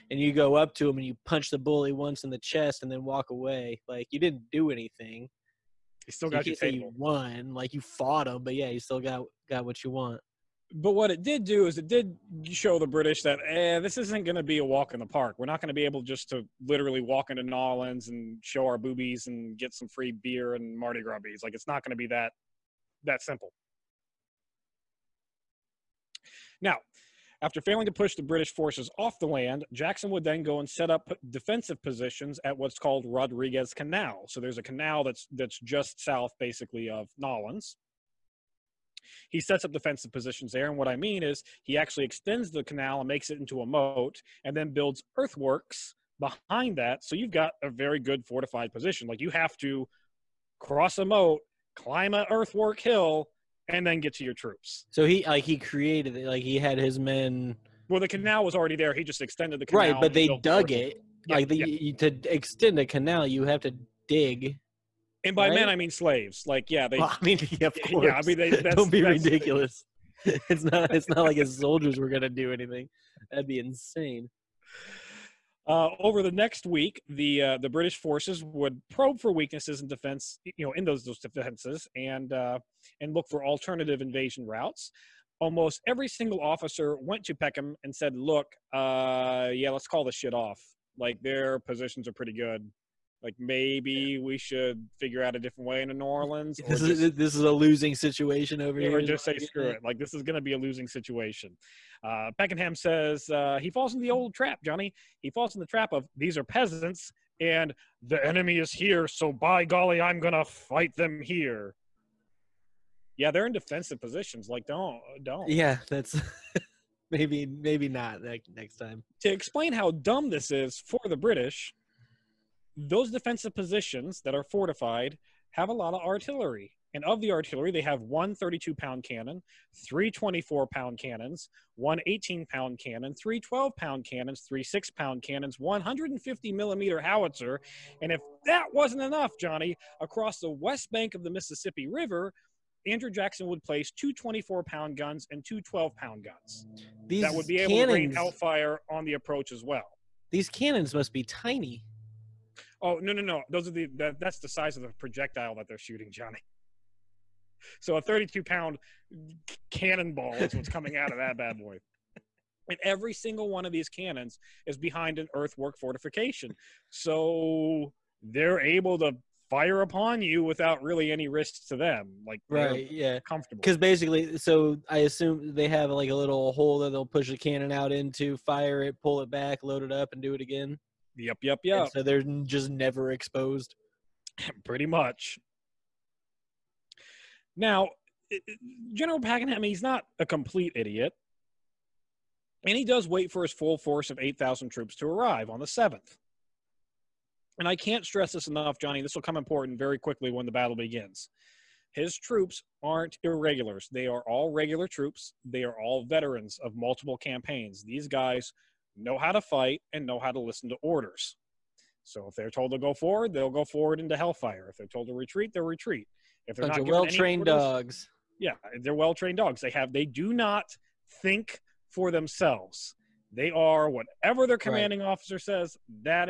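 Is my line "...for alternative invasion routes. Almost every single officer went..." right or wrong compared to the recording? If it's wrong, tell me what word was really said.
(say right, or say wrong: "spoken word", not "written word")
right.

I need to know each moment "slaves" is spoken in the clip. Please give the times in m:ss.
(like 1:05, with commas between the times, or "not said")
1:05.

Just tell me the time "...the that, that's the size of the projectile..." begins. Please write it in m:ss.
2:33.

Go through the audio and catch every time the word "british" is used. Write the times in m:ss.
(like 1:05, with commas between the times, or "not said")
0:12, 0:28, 1:17, 2:01.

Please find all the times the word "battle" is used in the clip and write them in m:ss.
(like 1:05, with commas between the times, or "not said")
3:20.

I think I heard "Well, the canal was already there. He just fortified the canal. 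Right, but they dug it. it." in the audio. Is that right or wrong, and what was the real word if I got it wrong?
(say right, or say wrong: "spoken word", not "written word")
wrong: "extended", not "fortified".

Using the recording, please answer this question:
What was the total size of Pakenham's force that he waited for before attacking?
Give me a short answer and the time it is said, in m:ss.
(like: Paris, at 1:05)
8,000 troops, at 3:14.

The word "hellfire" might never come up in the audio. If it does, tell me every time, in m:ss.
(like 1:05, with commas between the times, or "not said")
2:28, 3:34.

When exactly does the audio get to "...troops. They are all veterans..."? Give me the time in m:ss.
3:24.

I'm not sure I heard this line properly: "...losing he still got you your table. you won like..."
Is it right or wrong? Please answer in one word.
wrong.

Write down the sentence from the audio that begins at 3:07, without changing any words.
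Now, General Pakenham, he's not a complete idiot.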